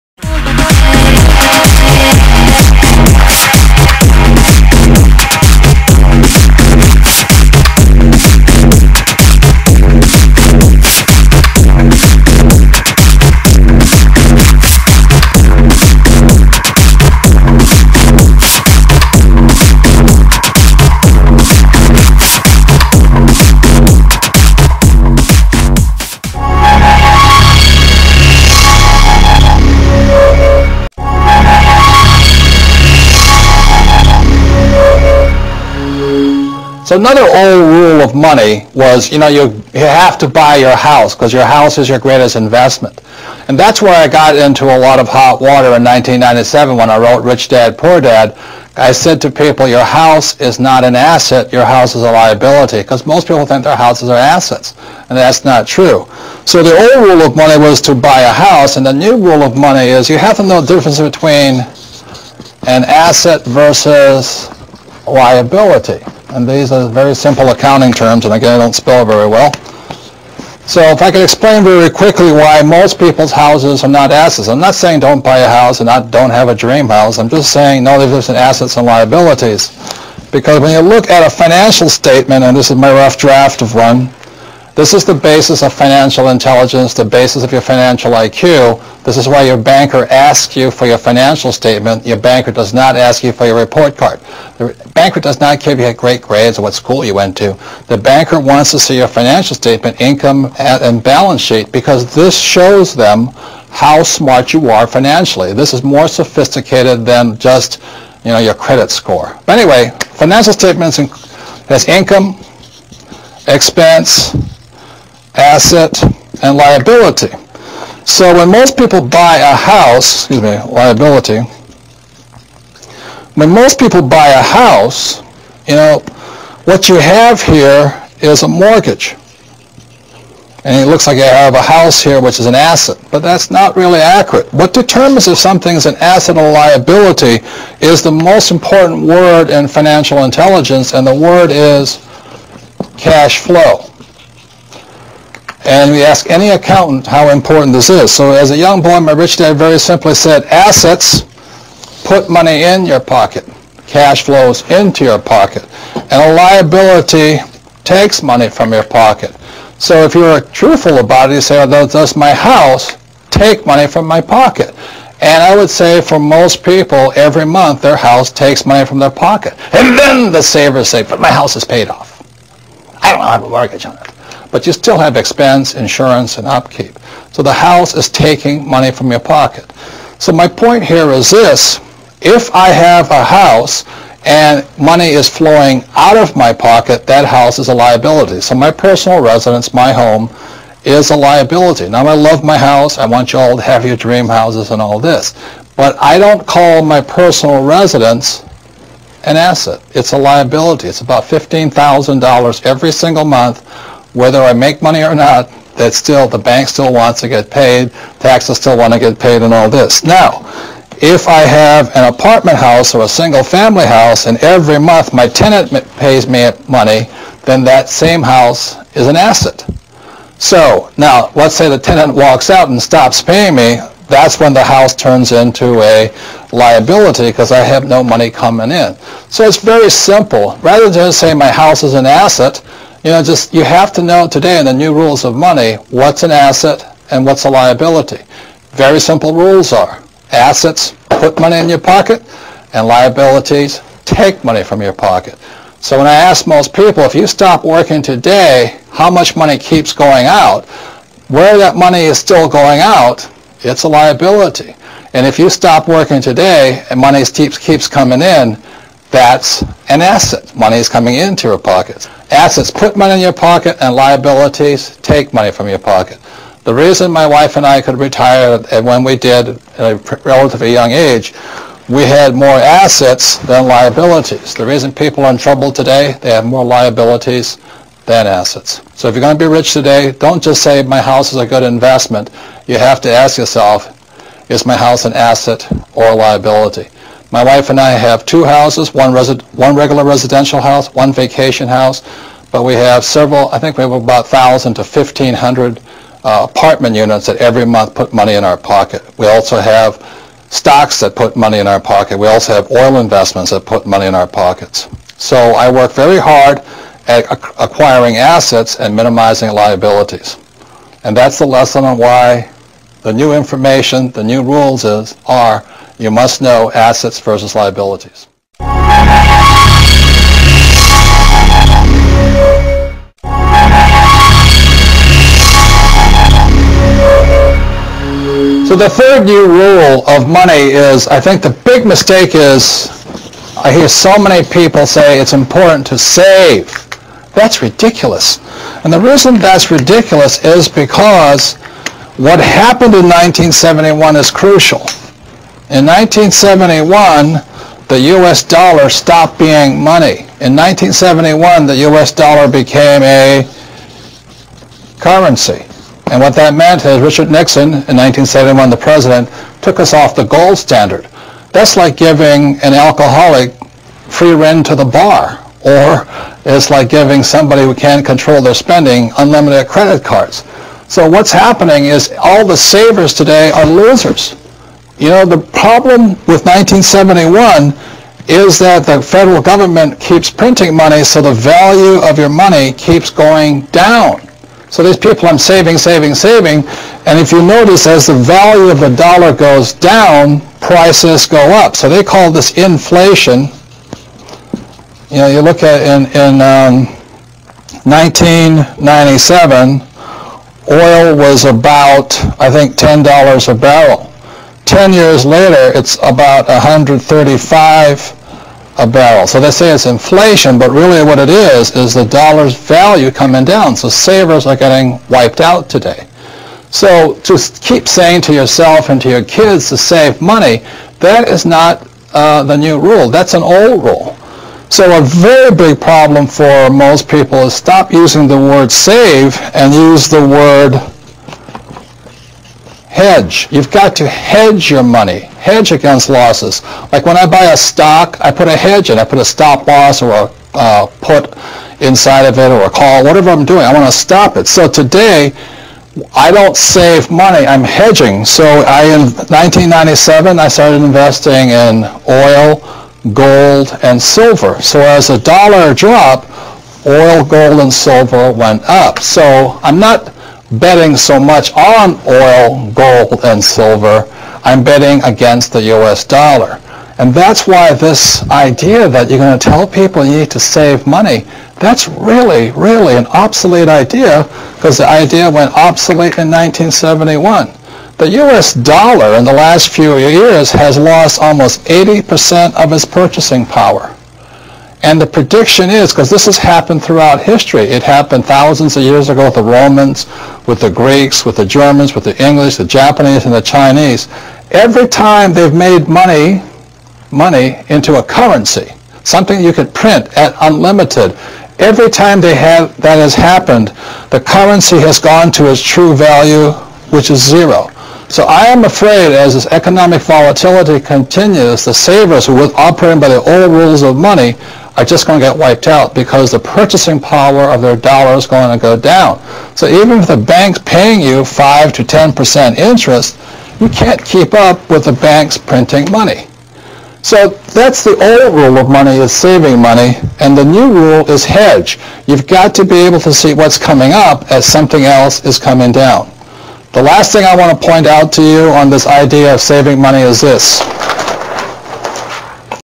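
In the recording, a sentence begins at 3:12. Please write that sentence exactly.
I want you all to have your dream houses and all this.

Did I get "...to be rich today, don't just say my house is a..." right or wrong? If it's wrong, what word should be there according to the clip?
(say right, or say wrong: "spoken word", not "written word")
right.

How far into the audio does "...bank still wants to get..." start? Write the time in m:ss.
3:26.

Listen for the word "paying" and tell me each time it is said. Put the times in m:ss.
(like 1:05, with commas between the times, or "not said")
3:43, 8:40.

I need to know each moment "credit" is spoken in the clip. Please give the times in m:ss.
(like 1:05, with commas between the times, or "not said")
1:48, 6:09.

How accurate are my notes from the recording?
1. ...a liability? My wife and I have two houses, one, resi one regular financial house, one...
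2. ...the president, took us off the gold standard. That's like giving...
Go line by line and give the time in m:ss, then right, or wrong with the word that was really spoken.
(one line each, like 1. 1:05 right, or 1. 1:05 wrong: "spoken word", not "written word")
1. 4:46 wrong: "residential", not "financial"
2. 5:58 right.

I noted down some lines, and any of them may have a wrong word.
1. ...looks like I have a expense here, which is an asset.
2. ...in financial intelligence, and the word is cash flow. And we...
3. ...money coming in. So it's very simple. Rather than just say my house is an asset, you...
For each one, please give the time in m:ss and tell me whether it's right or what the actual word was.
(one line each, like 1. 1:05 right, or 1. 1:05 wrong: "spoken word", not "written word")
1. 2:10 wrong: "house", not "expense"
2. 2:19 right
3. 3:48 right.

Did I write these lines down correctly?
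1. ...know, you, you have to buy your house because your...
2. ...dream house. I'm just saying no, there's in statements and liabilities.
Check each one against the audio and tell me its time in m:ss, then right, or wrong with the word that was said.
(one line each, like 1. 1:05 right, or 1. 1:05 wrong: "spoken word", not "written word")
1. 0:39 right
2. 1:16 wrong: "assets", not "statements".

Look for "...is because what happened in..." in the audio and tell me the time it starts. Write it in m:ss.
5:40.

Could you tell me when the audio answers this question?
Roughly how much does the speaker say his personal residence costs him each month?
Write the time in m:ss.
3:21.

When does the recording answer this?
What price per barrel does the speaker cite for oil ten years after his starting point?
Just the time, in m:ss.
6:46.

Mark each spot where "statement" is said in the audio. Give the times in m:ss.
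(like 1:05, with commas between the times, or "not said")
1:21, 1:31, 1:39, 1:50.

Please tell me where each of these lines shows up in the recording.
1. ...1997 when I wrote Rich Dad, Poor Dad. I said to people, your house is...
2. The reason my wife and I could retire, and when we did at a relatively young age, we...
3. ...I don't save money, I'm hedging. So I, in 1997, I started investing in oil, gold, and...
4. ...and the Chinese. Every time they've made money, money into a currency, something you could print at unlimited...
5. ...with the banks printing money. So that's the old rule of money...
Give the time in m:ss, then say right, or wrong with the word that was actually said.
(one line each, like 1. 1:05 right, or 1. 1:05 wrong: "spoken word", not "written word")
1. 0:45 right
2. 4:26 right
3. 7:26 right
4. 8:13 right
5. 8:44 right.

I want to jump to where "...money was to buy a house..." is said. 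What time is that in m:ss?
0:57.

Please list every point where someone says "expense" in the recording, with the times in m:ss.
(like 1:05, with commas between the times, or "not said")
1:53, 2:55.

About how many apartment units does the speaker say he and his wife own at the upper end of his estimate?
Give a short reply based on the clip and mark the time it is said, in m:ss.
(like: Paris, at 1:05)
1,500, at 4:54.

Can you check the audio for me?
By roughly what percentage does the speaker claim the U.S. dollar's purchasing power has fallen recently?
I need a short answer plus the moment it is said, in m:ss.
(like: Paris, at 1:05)
80%, at 8:01.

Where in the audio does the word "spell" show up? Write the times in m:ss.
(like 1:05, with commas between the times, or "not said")
1:08.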